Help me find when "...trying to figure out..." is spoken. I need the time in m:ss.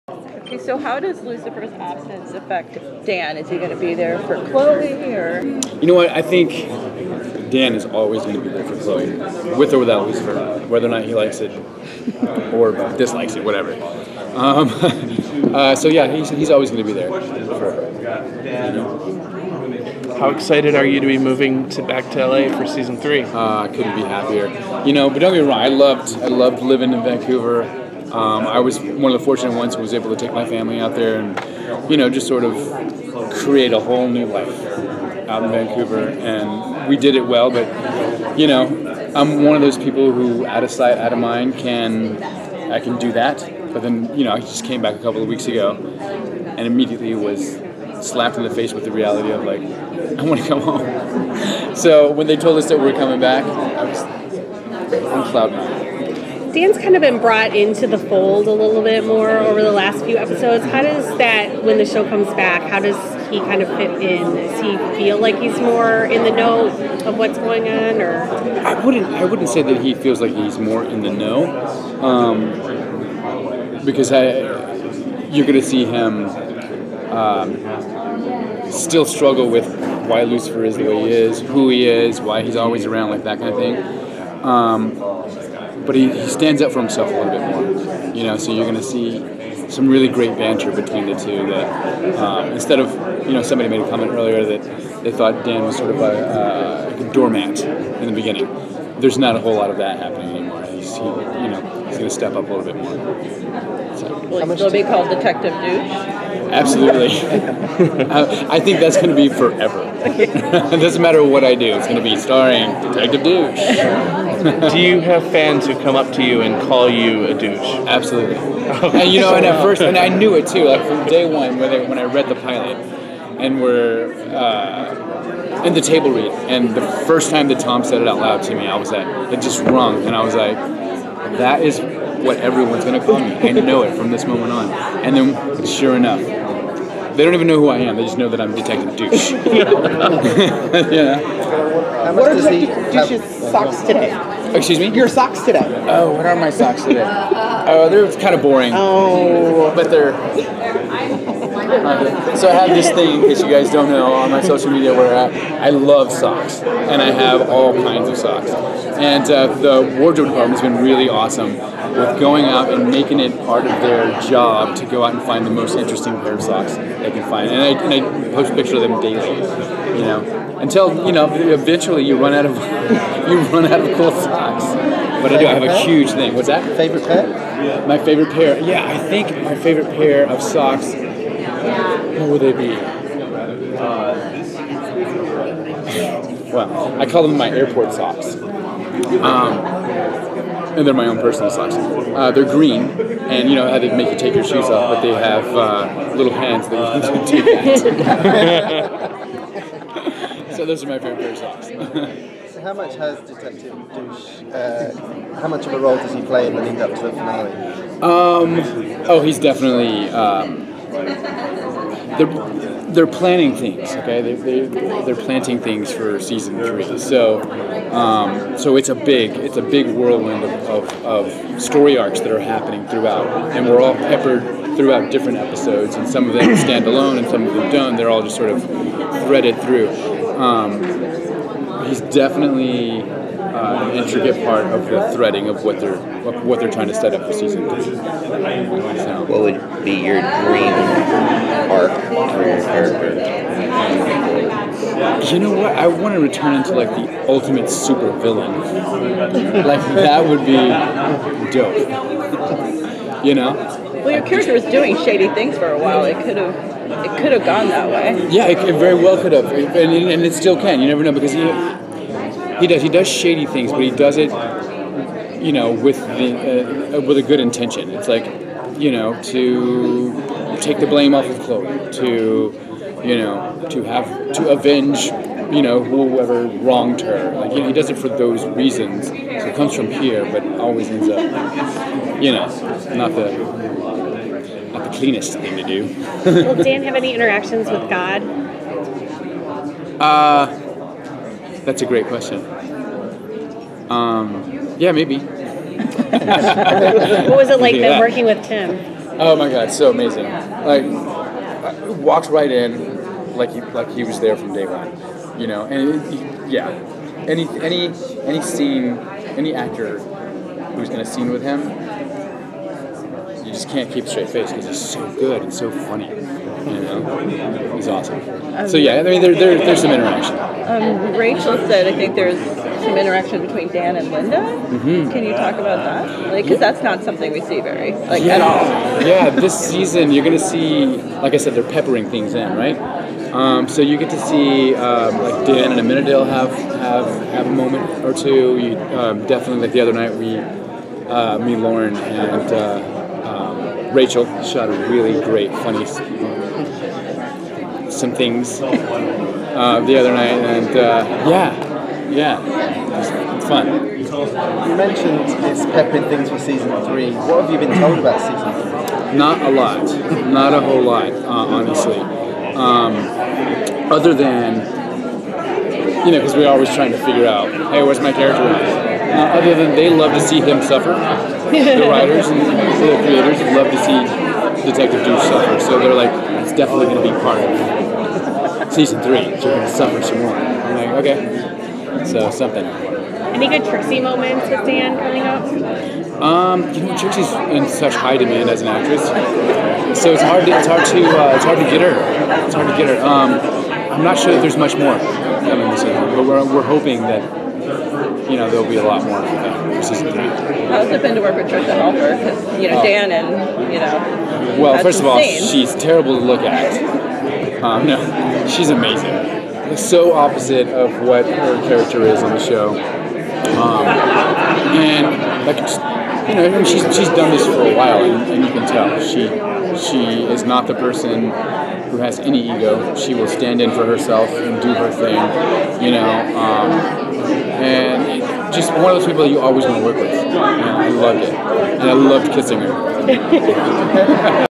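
6:06.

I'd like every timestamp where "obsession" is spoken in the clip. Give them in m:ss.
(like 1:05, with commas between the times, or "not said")
not said.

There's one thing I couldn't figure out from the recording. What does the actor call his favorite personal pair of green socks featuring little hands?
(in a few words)
airport socks.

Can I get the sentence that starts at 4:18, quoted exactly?
Yeah, it, it very well could have, and, and, it still can.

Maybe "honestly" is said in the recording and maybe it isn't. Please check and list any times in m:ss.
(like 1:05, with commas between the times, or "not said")
6:01.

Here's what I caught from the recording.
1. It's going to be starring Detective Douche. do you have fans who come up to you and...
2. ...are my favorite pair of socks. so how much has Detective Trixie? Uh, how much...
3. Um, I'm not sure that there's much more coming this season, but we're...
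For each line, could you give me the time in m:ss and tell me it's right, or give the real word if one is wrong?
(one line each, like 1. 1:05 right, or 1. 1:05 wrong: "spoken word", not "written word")
1. 1:51 right
2. 3:20 wrong: "Douche", not "Trixie"
3. 6:33 right.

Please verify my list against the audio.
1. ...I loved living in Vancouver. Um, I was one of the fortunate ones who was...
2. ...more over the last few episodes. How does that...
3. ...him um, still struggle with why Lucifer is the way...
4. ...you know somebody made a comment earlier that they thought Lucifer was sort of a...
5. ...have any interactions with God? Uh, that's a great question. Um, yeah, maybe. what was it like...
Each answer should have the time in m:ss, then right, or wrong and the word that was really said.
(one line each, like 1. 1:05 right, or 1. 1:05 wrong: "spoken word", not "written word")
1. 0:26 right
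2. 0:59 right
3. 1:15 right
4. 1:33 wrong: "Dan", not "Lucifer"
5. 4:46 right.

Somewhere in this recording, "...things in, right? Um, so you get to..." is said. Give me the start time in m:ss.
5:32.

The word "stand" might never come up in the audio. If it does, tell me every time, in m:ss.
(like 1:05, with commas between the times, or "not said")
1:26, 3:46, 7:03.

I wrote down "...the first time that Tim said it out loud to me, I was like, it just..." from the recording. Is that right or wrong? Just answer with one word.
wrong.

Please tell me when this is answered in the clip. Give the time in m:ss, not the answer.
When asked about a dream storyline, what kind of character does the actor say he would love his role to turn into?
4:06.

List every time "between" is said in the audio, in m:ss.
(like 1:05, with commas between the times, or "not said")
1:30, 5:23.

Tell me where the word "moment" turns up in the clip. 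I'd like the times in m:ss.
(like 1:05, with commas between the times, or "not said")
2:14, 5:37, 6:24.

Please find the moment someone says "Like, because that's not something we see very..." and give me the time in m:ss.
5:26.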